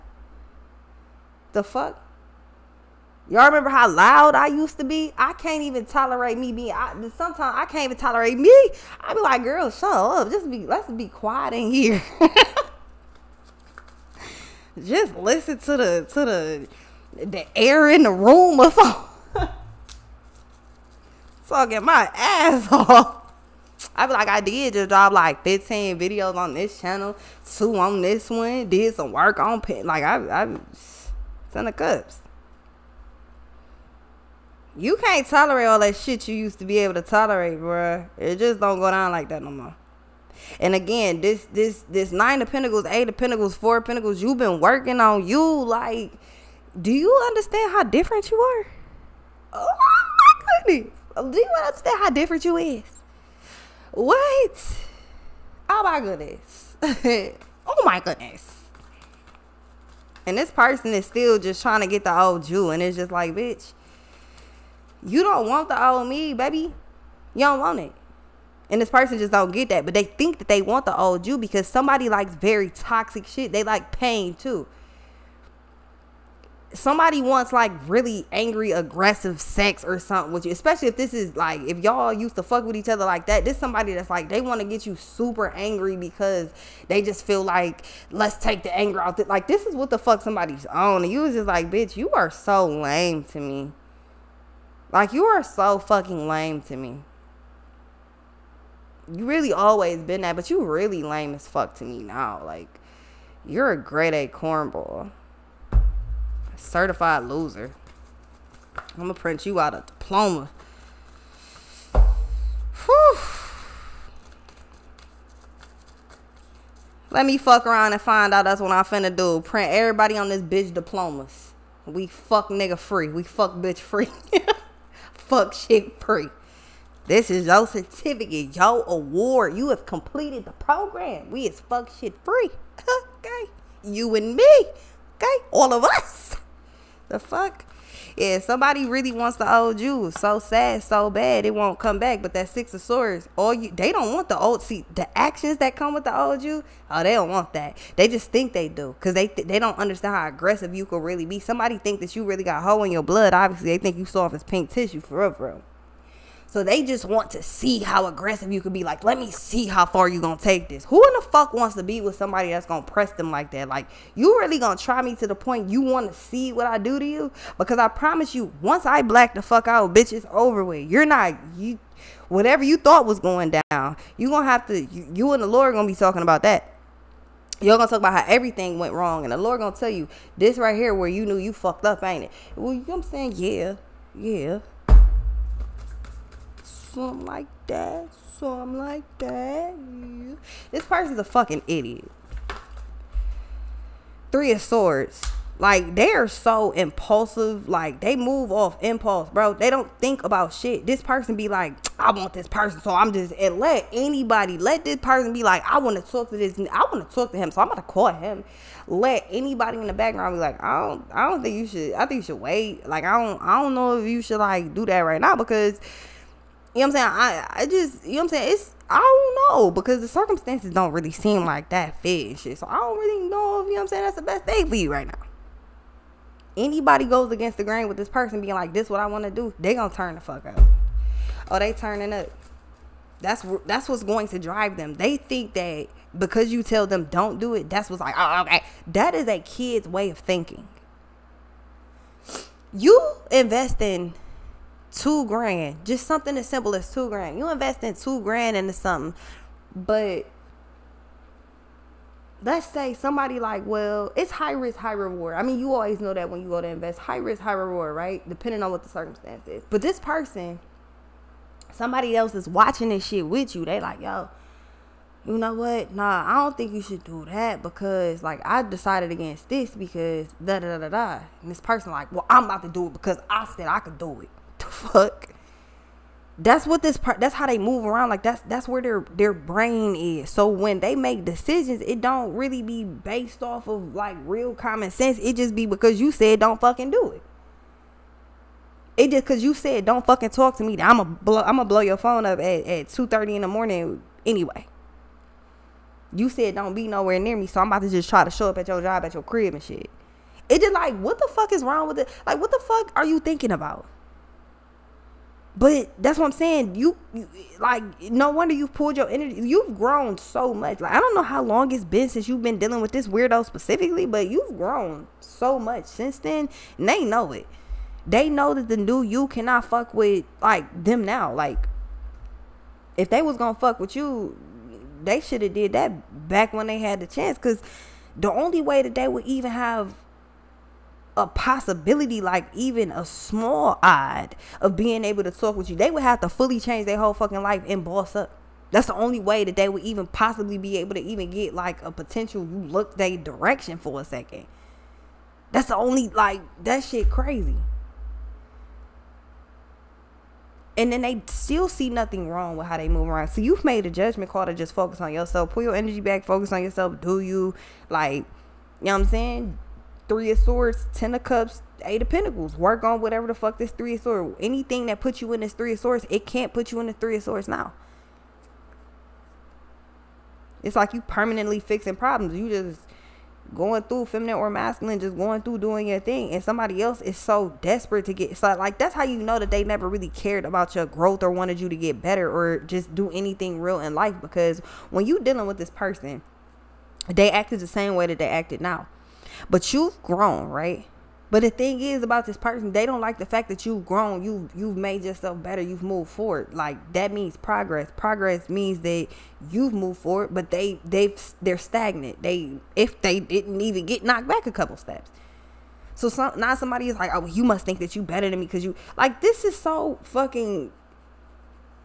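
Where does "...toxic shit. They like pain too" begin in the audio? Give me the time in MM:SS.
01:12.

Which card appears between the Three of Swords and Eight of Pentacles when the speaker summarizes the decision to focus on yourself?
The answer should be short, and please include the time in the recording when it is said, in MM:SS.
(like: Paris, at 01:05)
Ten of Cups, at 06:00.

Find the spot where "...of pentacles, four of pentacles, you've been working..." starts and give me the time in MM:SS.
00:43.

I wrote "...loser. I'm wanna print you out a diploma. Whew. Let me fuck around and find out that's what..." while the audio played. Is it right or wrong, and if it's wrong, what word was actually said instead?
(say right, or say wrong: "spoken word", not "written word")
wrong: "gonna", not "wanna".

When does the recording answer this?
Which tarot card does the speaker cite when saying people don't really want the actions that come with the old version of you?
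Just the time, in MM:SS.
02:22.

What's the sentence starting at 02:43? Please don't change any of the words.
Like, you really gonna try me to the point you wanna see what I do to you?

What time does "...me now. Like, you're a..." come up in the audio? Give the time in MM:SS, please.
01:41.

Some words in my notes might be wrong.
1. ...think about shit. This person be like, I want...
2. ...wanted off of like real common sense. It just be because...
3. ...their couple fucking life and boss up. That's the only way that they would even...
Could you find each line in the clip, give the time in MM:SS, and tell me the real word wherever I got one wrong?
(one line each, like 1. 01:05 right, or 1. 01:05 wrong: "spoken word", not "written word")
1. 03:19 right
2. 04:42 wrong: "based", not "wanted"
3. 05:36 wrong: "whole", not "couple".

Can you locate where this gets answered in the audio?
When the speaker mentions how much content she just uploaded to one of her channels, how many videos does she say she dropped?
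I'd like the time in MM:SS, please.
00:25.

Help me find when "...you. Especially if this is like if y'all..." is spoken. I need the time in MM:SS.
01:20.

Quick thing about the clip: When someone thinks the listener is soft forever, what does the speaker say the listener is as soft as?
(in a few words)
pink tissue.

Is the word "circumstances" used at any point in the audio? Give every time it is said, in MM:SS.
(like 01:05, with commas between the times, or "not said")
03:40, 04:18.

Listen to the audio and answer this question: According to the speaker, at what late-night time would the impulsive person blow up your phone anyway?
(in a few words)
2:30 in the morning.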